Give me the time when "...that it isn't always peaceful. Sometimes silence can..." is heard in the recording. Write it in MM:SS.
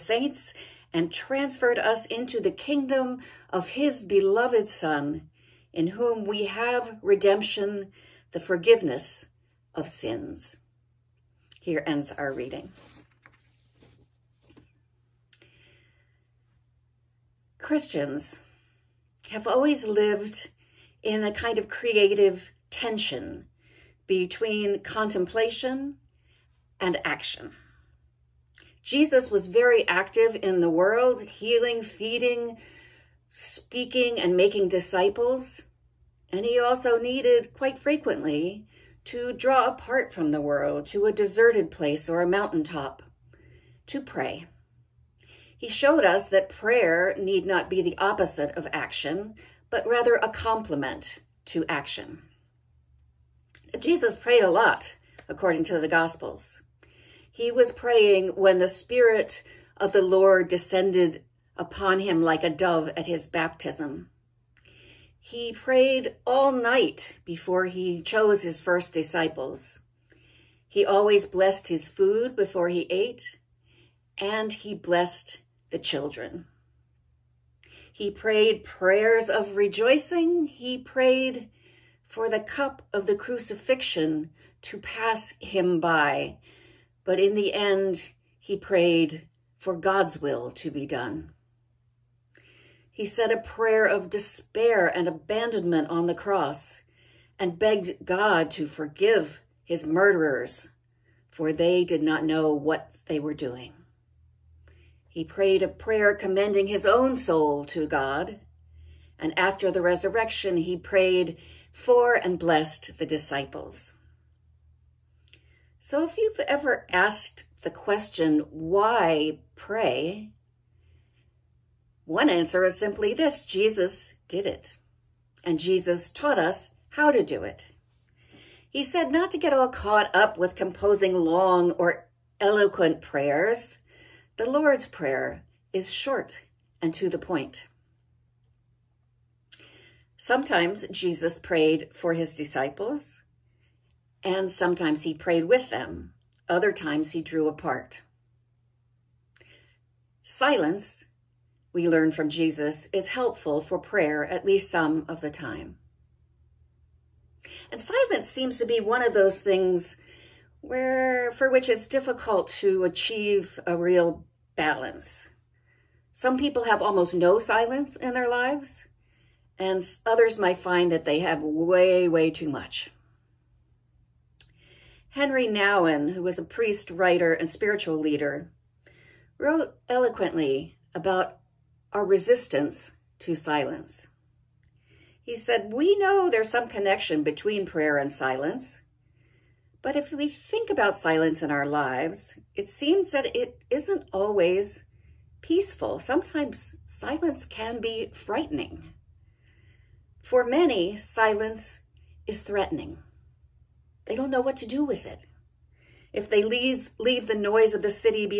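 03:13.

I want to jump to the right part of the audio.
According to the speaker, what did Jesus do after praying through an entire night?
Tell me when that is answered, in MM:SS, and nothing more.
01:08.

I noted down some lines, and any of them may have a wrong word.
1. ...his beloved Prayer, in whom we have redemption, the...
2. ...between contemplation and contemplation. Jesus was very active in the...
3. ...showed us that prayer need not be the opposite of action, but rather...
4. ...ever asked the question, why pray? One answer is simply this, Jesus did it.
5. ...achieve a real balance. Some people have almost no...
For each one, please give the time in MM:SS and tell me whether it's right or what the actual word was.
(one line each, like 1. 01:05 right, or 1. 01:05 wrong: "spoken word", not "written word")
1. 00:03 wrong: "Son", not "Prayer"
2. 00:24 wrong: "action", not "contemplation"
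3. 00:45 right
4. 01:56 right
5. 02:42 right.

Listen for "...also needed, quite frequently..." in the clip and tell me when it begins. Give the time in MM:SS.
00:36.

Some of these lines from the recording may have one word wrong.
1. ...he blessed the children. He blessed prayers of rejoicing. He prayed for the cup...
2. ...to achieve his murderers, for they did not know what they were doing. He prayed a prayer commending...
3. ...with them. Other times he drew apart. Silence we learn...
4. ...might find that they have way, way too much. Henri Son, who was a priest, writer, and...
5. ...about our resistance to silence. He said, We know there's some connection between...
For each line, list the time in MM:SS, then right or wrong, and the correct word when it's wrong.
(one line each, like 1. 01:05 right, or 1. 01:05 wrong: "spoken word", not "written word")
1. 01:14 wrong: "prayed", not "blessed"
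2. 01:38 wrong: "forgive", not "achieve"
3. 02:25 right
4. 02:50 wrong: "Nouwen", not "Son"
5. 03:00 right.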